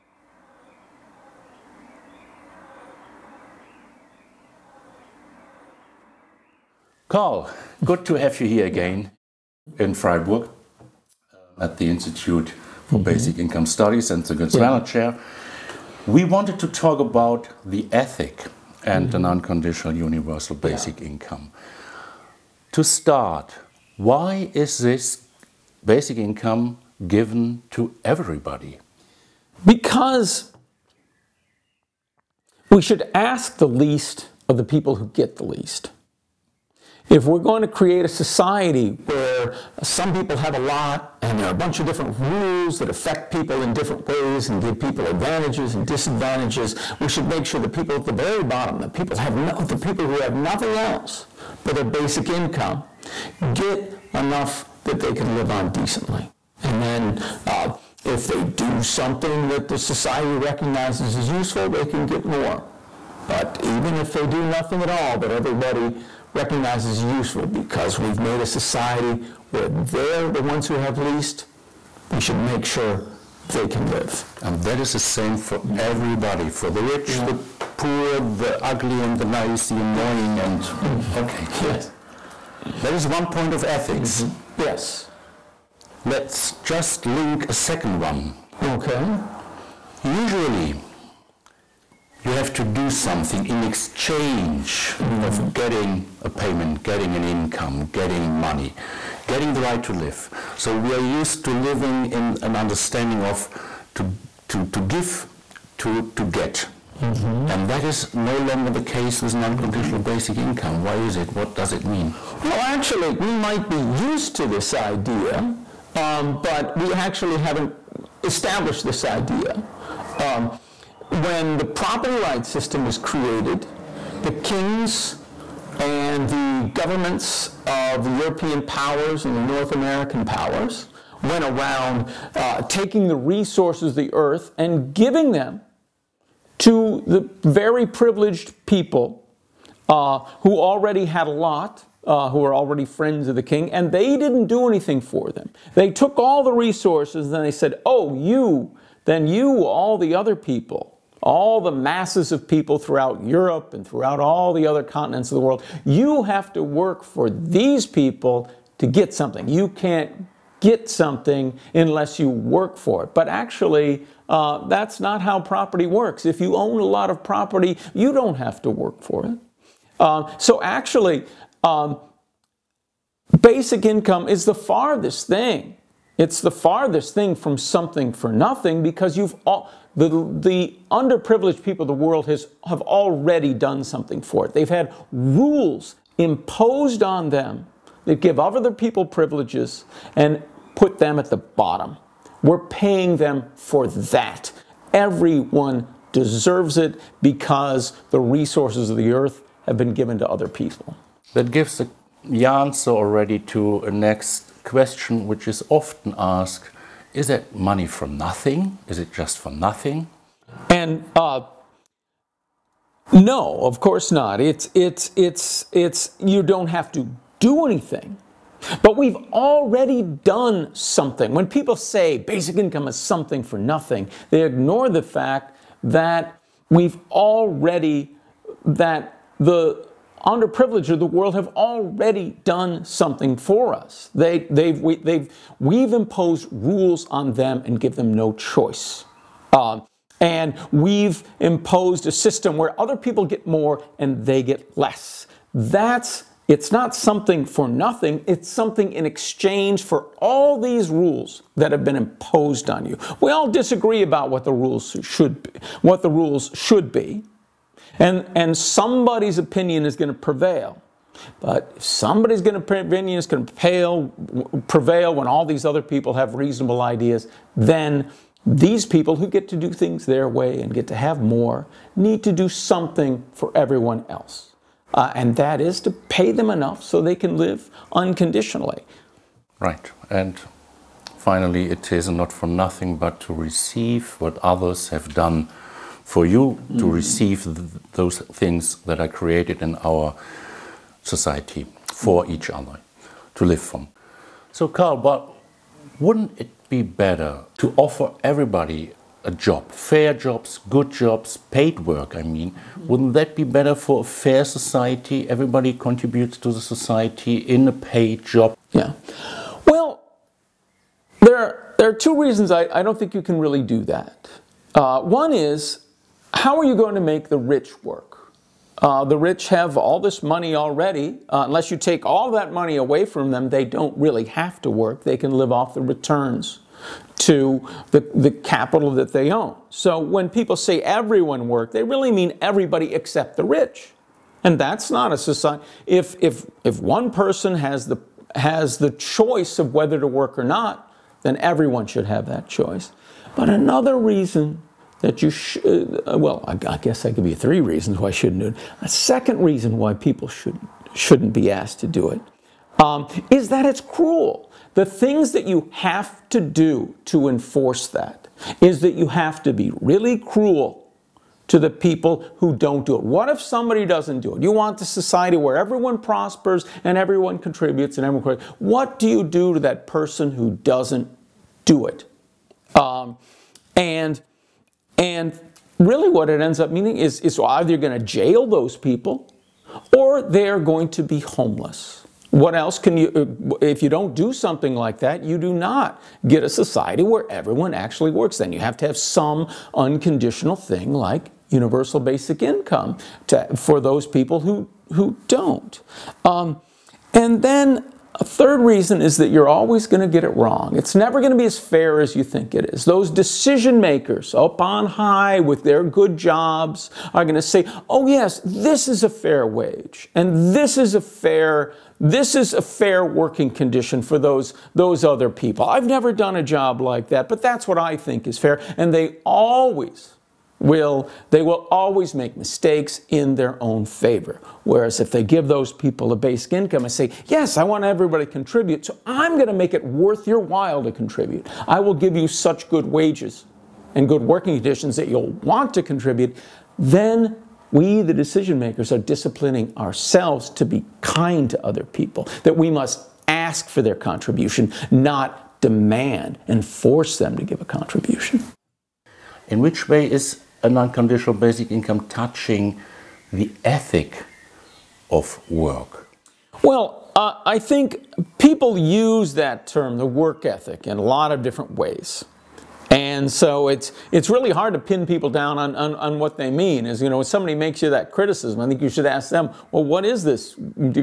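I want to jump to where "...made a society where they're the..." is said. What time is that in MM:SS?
01:08.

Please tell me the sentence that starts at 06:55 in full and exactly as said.
I've never done a job like that, but that's what I think is fair.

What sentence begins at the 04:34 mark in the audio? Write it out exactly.
Uh, and that is to pay them enough so they can live unconditionally.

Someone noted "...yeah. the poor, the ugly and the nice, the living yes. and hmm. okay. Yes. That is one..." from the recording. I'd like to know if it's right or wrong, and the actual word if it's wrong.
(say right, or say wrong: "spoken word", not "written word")
wrong: "annoying", not "living".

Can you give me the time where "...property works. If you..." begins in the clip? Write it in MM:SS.
02:45.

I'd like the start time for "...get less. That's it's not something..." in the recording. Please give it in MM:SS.
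04:04.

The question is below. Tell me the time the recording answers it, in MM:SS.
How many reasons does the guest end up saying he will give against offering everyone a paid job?
05:47.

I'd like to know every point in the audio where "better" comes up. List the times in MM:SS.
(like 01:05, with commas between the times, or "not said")
04:57, 05:03.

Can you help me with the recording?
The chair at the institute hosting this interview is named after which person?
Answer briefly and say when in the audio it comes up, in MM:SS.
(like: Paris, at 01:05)
Götz Werner, at 00:14.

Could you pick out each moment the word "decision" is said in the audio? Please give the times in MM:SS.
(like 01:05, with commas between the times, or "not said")
06:43, 07:18.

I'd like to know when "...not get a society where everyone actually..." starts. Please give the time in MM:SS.
06:25.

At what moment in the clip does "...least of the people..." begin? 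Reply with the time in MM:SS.
00:33.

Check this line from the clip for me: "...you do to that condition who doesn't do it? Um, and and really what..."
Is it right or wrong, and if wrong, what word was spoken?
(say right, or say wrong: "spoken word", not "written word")
wrong: "person", not "condition".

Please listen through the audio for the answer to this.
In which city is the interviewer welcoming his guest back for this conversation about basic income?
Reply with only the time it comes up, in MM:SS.
00:09.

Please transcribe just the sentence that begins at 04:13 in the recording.
We all disagree about what the rules should be, what the rules should be.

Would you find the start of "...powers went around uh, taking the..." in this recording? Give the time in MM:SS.
02:10.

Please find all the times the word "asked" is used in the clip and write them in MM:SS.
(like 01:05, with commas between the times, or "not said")
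03:26, 05:51.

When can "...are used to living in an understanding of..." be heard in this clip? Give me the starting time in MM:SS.
01:40.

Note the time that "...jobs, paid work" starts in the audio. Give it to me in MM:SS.
05:01.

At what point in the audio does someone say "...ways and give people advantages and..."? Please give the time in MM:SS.
00:44.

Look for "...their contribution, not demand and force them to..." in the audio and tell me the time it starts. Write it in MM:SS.
07:23.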